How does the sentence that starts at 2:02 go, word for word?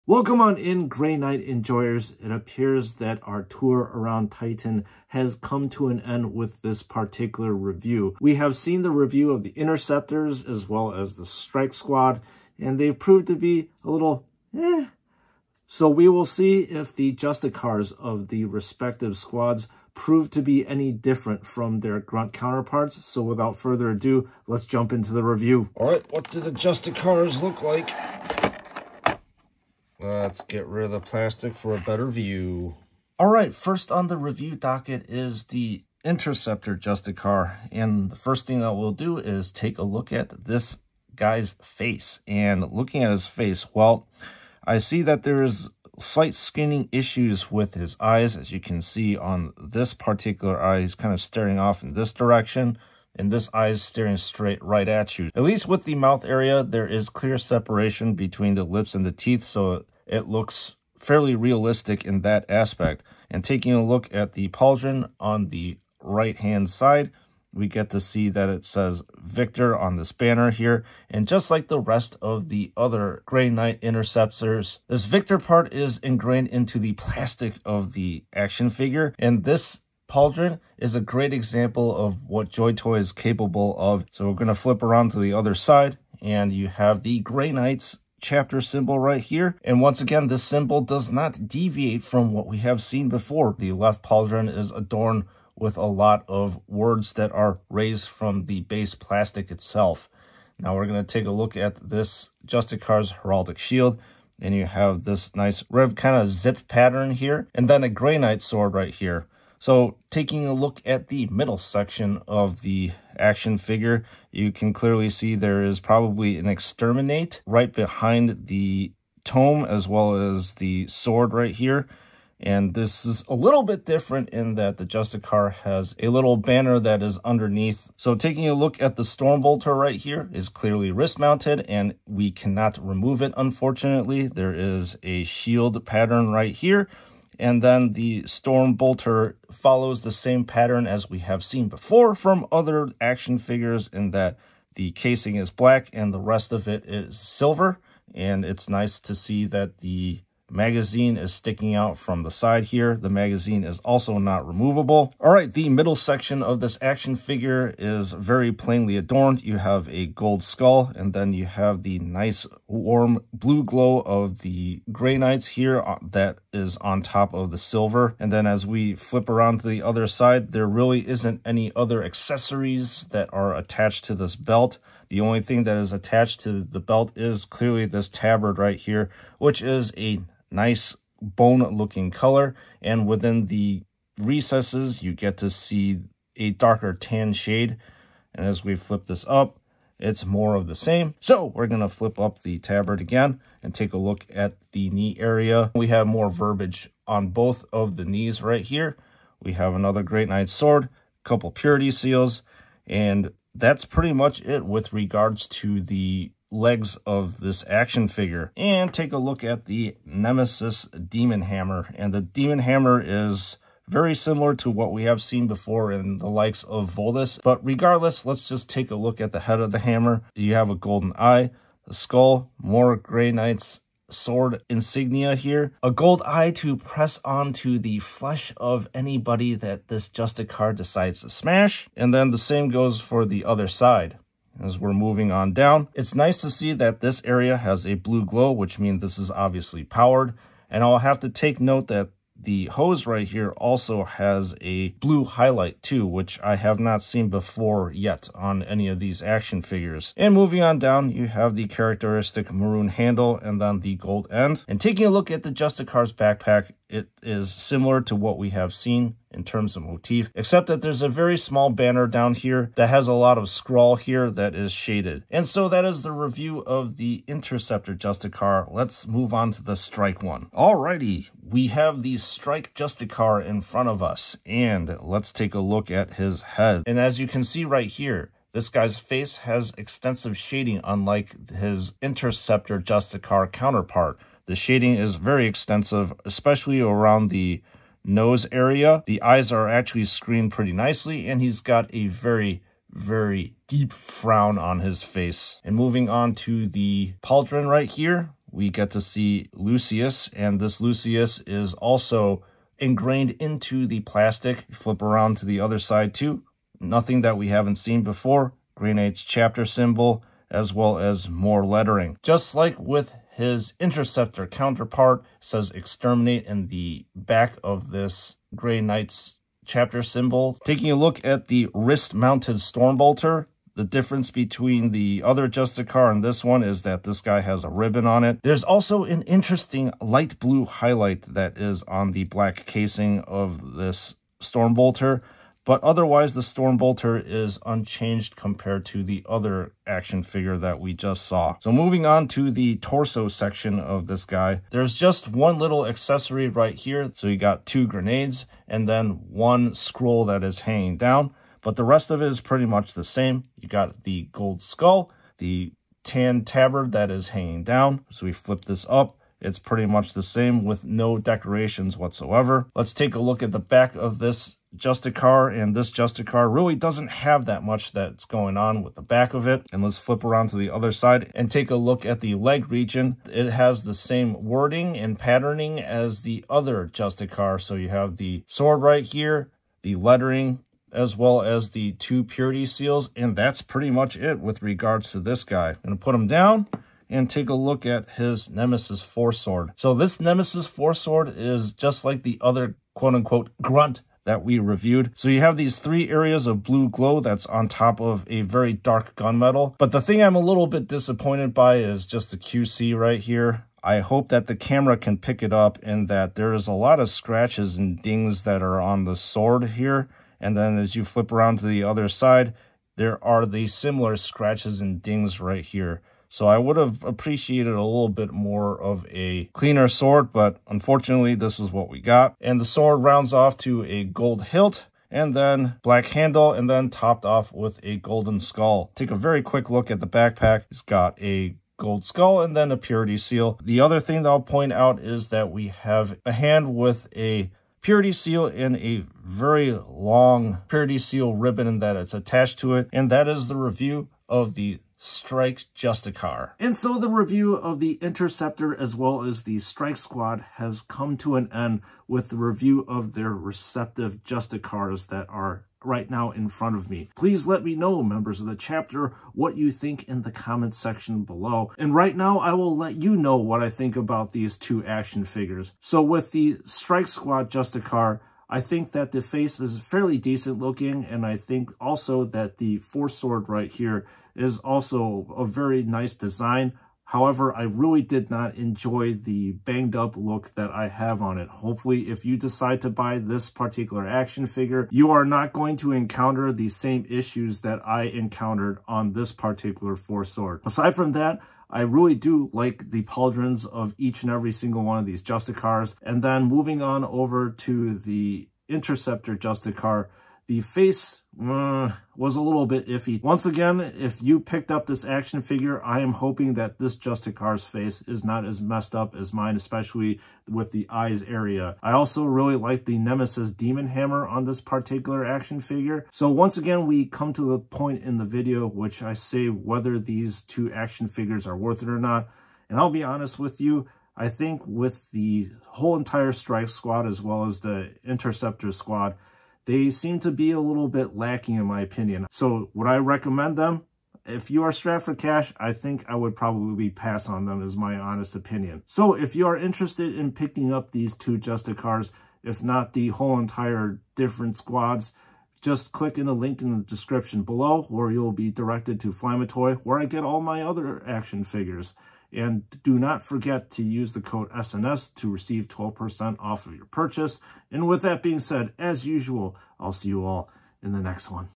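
And this is a little bit different in that the Justicar has a little banner that is underneath.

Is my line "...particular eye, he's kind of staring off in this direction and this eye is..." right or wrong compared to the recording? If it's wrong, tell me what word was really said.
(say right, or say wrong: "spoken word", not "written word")
right.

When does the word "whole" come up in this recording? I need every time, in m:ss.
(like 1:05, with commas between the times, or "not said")
8:45, 9:03.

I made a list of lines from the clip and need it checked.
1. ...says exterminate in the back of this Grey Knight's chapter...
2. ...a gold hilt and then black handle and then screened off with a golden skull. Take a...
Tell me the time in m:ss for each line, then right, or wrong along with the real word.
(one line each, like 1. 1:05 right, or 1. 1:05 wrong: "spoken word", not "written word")
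1. 5:15 right
2. 7:03 wrong: "topped", not "screened".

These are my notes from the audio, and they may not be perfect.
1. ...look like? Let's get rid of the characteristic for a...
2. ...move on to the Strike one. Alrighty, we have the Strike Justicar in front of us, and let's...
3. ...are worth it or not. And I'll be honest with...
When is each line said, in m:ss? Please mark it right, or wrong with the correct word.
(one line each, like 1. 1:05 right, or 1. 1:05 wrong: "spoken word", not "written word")
1. 0:27 wrong: "plastic", not "characteristic"
2. 4:29 right
3. 8:41 right.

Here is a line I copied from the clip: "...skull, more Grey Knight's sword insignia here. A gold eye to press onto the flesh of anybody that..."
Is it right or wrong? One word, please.
right.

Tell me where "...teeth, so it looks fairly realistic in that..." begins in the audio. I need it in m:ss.
0:59.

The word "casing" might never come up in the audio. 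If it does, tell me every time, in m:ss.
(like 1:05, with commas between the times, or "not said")
2:24, 5:32.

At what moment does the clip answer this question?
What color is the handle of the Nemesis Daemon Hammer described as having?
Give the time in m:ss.
4:12.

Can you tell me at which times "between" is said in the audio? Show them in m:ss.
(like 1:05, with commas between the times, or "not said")
0:58, 5:24.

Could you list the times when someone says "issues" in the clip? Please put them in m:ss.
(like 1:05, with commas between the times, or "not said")
0:46, 8:07.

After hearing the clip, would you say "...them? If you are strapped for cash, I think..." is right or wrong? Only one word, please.
right.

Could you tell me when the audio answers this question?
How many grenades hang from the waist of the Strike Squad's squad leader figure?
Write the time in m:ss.
5:47.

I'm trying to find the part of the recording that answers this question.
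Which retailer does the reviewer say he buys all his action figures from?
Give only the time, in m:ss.
9:09.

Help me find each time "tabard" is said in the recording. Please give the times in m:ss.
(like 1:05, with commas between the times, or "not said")
2:58, 3:12, 5:56.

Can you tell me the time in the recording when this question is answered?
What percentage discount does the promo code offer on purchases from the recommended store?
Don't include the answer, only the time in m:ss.
9:15.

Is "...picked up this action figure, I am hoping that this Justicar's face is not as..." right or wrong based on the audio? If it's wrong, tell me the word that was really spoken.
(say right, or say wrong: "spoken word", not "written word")
right.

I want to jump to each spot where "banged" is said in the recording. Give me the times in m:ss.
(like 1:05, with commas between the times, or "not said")
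7:59.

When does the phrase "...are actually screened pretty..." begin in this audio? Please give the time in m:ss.
4:49.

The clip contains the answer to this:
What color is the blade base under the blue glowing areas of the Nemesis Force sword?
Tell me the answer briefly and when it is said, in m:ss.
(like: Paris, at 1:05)
Dark gunmetal, at 6:38.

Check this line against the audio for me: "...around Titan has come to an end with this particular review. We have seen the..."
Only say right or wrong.
right.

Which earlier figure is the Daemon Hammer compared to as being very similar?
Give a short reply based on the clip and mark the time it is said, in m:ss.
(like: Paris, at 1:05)
Voldus, at 3:36.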